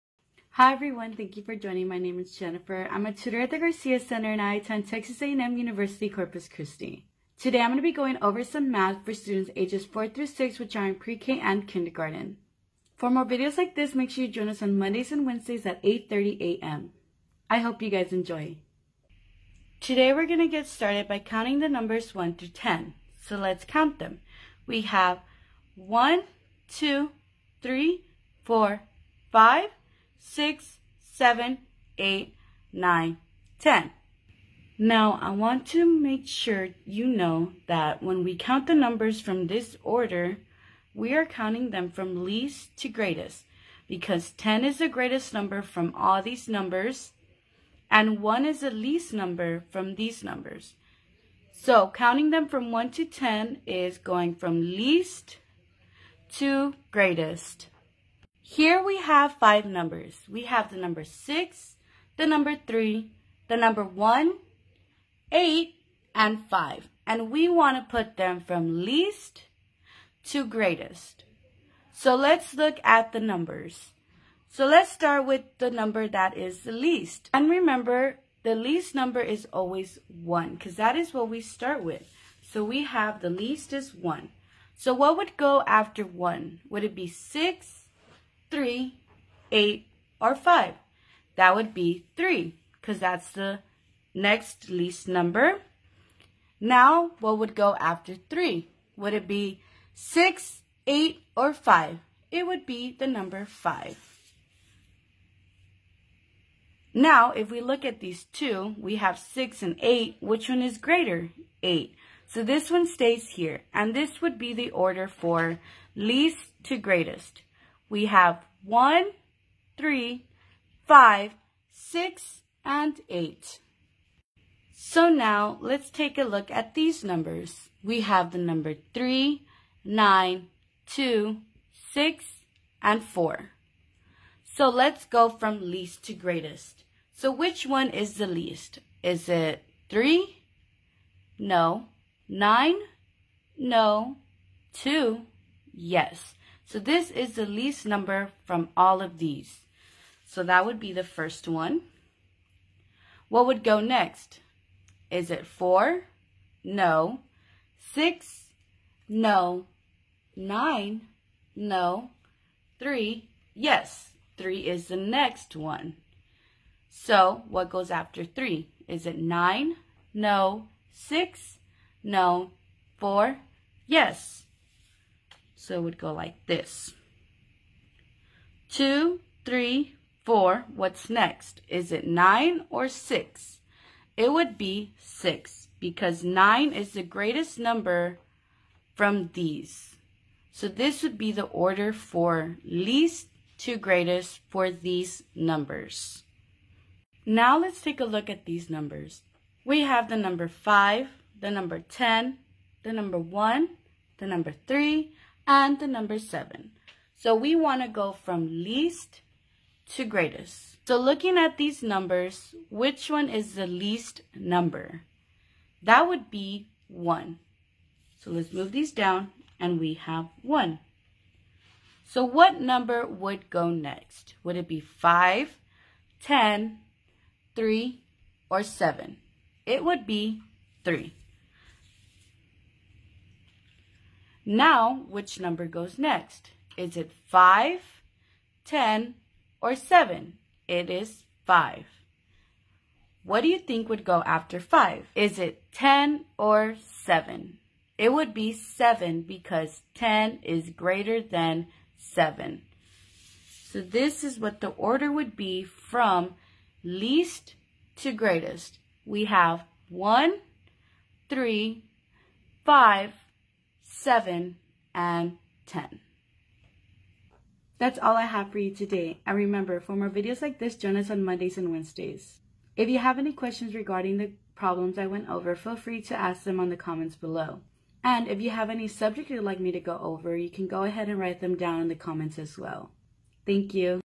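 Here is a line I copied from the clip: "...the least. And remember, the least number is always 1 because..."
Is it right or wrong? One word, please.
right.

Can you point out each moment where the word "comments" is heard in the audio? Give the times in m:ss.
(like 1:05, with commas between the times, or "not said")
4:36, 4:42.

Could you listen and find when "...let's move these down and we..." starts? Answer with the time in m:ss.
3:38.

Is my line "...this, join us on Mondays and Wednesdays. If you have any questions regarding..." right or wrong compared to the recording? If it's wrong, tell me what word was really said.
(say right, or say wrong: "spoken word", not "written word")
right.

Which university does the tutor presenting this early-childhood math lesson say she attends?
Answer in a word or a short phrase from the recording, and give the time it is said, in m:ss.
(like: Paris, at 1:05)
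Texas A&M University Corpus Christi, at 0:04.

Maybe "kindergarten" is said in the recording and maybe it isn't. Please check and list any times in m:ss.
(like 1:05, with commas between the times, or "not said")
0:11.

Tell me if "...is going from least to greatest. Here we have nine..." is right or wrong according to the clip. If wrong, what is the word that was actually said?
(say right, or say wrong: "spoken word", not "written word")
wrong: "five", not "nine".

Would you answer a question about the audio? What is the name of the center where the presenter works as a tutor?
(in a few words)
Garcia Center.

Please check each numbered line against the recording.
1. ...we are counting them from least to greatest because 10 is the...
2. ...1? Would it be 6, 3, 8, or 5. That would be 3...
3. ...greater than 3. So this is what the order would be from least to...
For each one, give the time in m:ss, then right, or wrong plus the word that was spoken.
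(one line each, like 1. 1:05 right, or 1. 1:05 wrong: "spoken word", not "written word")
1. 0:40 right
2. 1:26 right
3. 4:10 wrong: "7", not "3".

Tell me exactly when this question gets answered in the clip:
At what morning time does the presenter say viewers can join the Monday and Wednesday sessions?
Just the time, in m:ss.
0:15.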